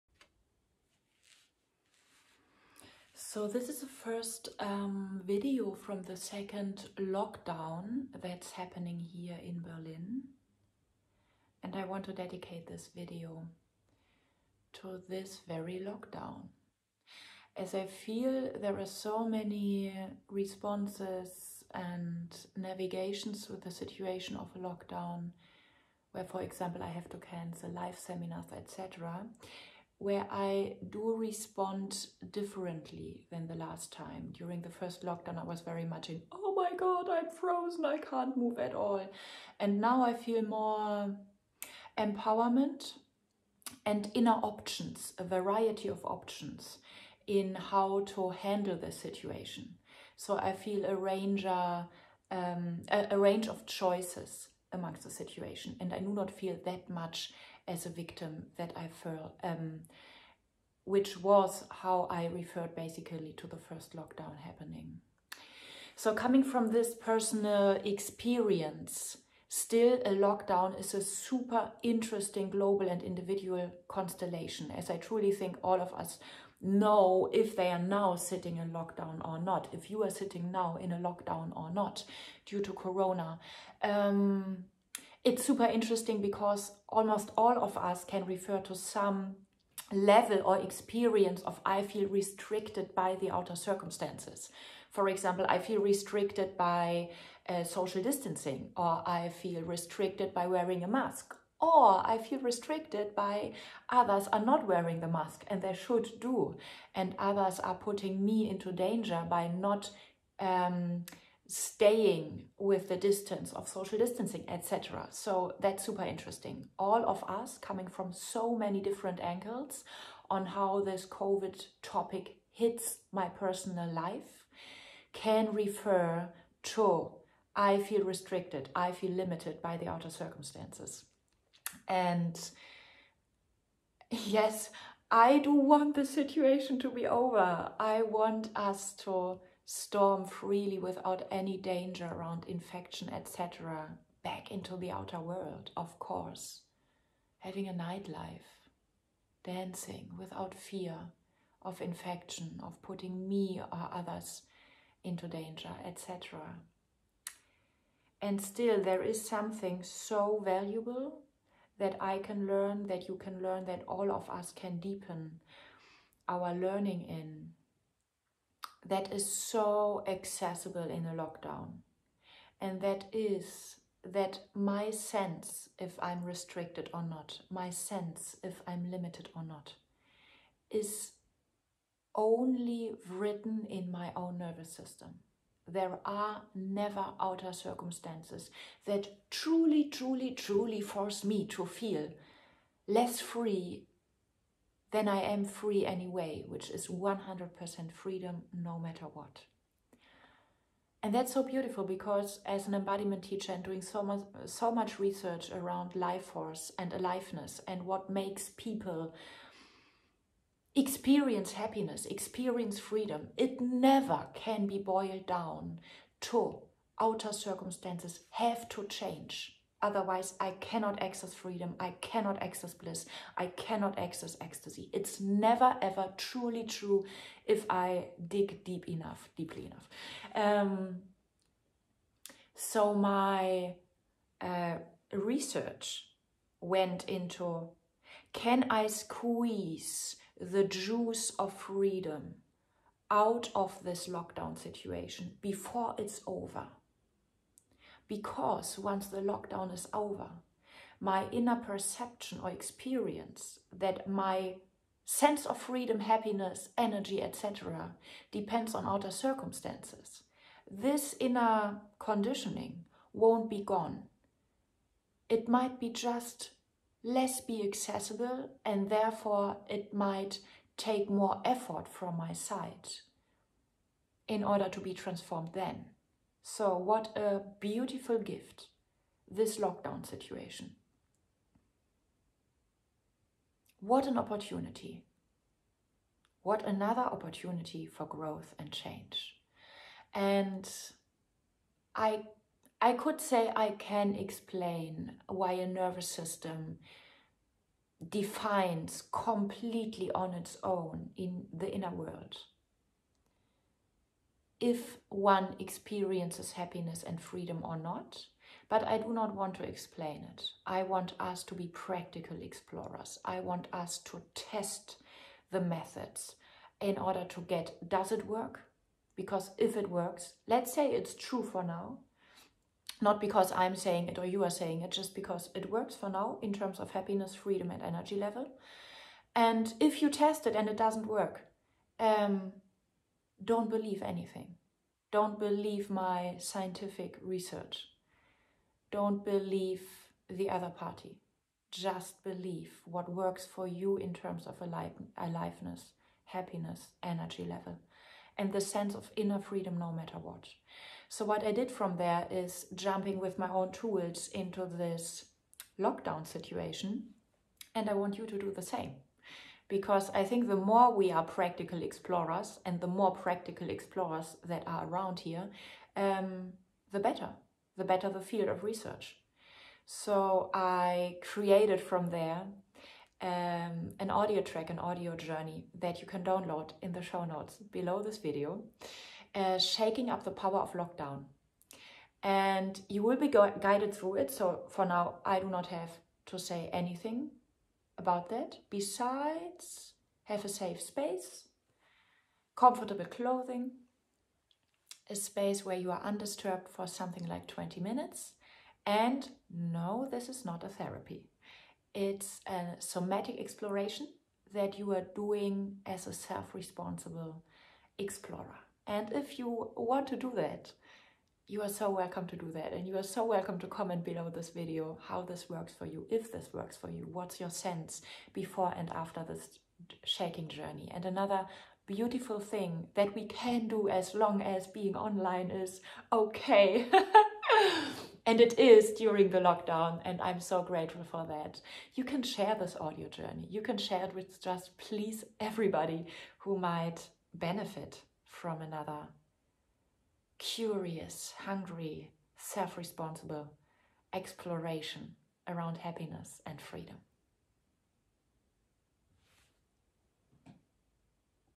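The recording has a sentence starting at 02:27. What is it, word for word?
Having a nightlife, dancing without fear of infection, of putting me or others into danger, etc.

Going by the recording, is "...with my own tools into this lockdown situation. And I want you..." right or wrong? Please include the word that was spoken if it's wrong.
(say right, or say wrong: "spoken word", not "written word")
right.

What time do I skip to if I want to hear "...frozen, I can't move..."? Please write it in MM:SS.
00:37.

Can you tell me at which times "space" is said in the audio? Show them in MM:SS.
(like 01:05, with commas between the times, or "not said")
06:30, 06:35.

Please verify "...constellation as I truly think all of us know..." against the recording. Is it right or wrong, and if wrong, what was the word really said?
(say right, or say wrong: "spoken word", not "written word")
right.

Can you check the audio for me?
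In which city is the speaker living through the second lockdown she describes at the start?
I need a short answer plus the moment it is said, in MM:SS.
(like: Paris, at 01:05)
Berlin, at 00:09.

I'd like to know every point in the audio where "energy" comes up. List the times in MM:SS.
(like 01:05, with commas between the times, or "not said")
04:16, 05:27, 05:47.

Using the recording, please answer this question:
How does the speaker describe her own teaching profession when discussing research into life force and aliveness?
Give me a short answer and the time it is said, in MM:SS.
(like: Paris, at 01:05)
Embodiment teacher, at 03:22.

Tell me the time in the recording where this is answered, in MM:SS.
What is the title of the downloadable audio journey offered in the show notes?
06:19.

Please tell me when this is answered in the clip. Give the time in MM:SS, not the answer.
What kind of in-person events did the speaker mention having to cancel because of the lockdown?
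00:27.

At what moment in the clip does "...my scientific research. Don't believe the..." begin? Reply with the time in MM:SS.
05:35.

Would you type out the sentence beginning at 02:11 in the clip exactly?
And yes, I do want the situation to be over.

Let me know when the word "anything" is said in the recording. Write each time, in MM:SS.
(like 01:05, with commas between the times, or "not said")
05:34, 06:26.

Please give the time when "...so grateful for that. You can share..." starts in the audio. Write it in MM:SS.
07:10.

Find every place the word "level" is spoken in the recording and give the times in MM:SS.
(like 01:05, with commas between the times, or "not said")
01:29, 05:28, 05:47.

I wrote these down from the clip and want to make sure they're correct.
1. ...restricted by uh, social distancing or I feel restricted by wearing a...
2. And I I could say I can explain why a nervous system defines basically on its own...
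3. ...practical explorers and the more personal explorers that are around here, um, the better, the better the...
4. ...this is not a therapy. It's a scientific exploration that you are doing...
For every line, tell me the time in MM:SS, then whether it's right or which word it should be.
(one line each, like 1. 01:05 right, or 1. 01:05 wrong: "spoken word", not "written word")
1. 01:35 right
2. 04:50 wrong: "completely", not "basically"
3. 06:01 wrong: "practical", not "personal"
4. 06:40 wrong: "somatic", not "scientific".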